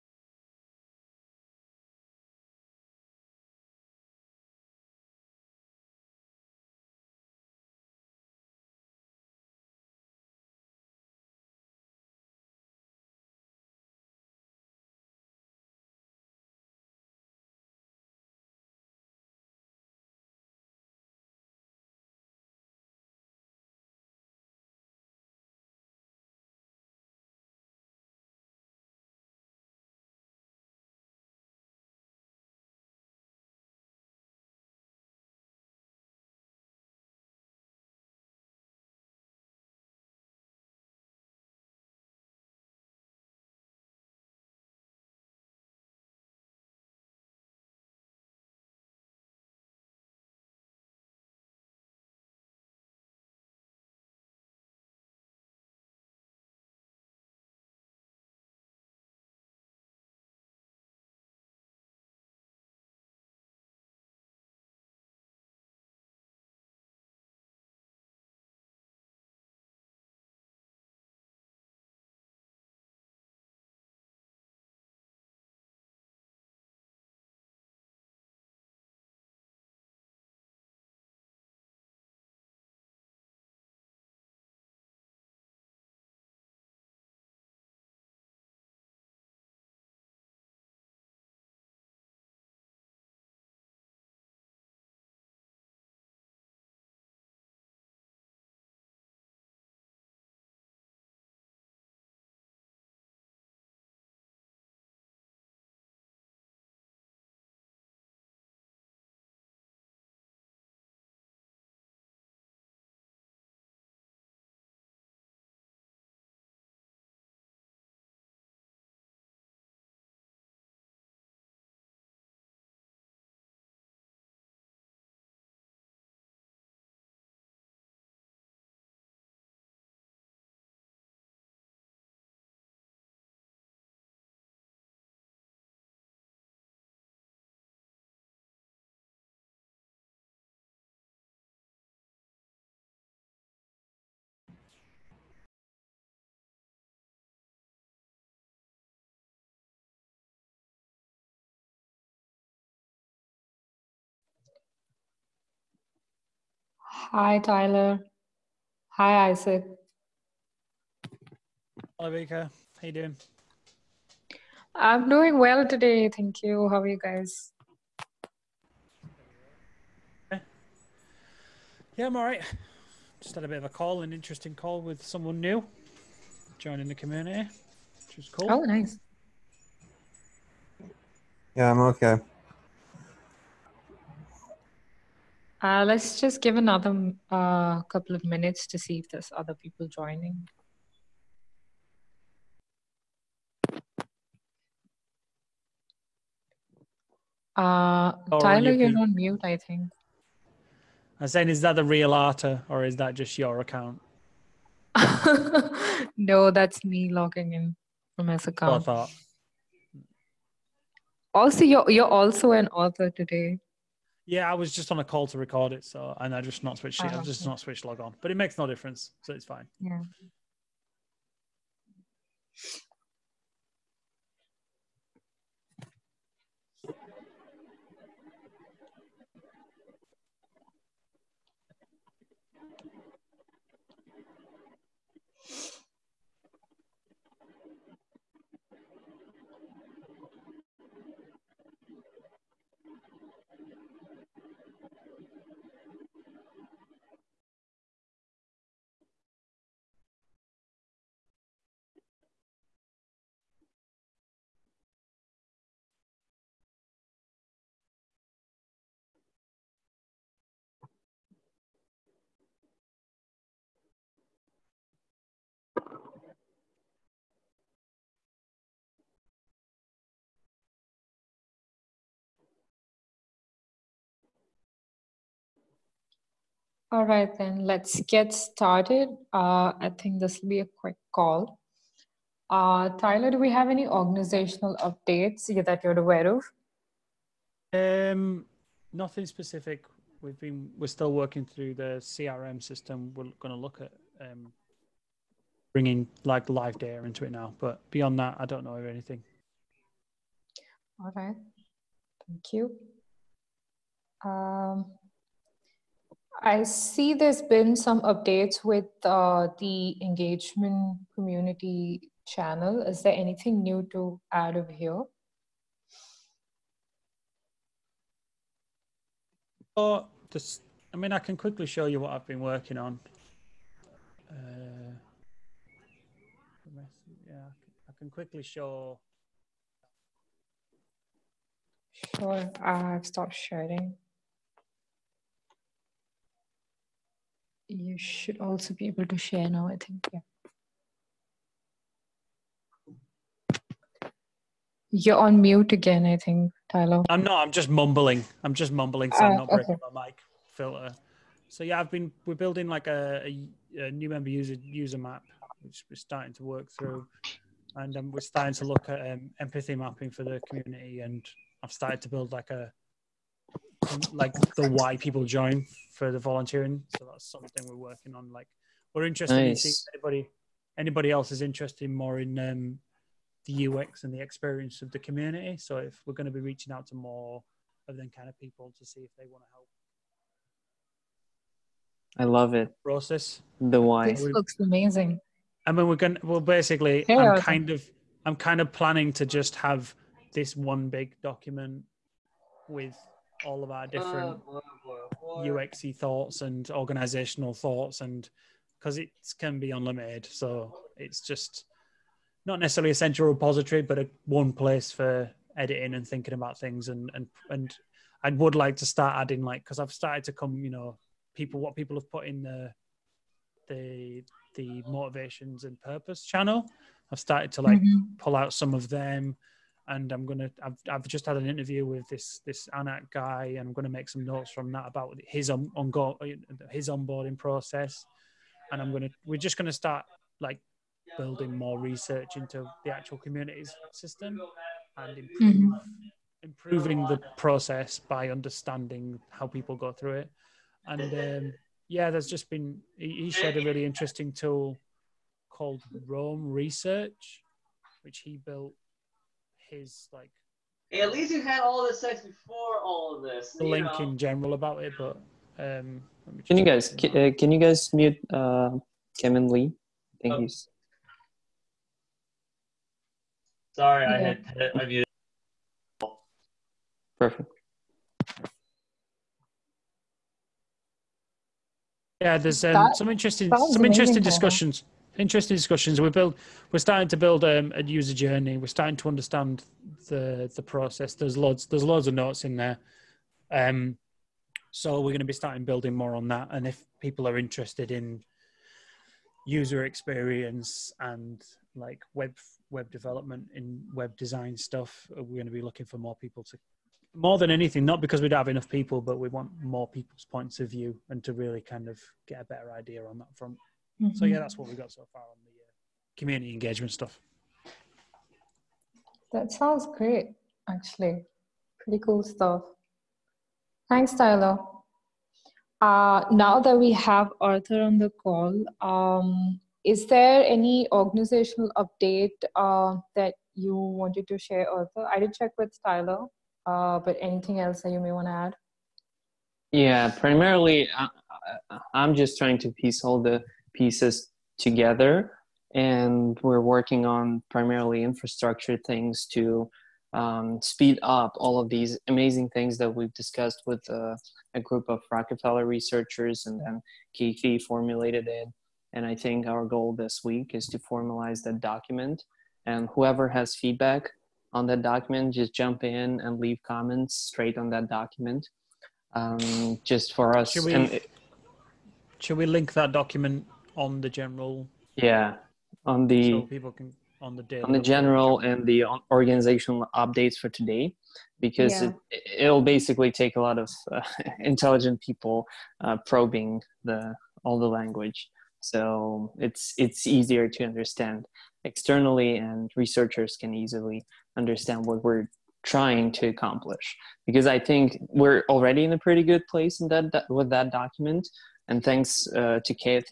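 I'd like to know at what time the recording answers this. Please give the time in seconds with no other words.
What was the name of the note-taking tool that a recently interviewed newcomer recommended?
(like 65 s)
446 s.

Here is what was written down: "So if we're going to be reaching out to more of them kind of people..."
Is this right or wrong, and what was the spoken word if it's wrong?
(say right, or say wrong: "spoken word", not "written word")
right.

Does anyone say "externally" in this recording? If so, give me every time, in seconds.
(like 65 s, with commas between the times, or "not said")
581 s.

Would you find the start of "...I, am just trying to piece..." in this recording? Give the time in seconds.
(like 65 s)
531 s.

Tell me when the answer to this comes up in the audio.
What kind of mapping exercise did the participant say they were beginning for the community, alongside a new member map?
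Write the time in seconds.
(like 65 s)
359 s.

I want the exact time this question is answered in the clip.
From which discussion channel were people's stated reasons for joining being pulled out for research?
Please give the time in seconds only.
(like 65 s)
414 s.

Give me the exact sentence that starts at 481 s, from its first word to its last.
There's loads, there's loads of notes in there.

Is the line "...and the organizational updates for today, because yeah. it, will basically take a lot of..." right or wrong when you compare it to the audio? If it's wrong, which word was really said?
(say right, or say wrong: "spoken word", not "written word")
right.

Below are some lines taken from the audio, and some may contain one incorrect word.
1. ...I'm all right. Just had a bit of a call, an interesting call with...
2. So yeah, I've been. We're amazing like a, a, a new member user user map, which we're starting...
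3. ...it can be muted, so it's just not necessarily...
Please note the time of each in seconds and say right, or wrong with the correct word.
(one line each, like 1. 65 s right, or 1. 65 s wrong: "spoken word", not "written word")
1. 172 s right
2. 351 s wrong: "building", not "amazing"
3. 398 s wrong: "unlimited", not "muted".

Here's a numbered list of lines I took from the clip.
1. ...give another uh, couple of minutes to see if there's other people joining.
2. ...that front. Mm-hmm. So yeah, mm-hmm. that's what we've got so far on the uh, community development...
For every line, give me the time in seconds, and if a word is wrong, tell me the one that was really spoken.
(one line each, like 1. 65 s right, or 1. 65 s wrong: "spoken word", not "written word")
1. 186 s right
2. 503 s wrong: "engagement", not "development".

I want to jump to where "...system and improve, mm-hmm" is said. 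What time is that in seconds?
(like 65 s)
433 s.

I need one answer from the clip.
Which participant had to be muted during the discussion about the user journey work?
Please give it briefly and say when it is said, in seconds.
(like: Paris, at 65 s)
Kevin Lee, at 459 s.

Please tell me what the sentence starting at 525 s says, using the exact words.
I did check with Tyler, uh, but anything else that you may want to add?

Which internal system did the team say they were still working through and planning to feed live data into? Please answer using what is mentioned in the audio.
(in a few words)
CRM system.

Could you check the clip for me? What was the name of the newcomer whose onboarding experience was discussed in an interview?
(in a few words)
Anak.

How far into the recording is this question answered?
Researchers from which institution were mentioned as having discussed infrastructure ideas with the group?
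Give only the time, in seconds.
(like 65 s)
545 s.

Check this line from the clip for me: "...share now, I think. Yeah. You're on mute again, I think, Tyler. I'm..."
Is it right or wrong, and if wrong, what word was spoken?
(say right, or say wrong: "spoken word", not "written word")
right.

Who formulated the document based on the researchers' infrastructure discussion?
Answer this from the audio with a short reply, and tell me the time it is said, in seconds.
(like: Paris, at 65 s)
Kathy, at 547 s.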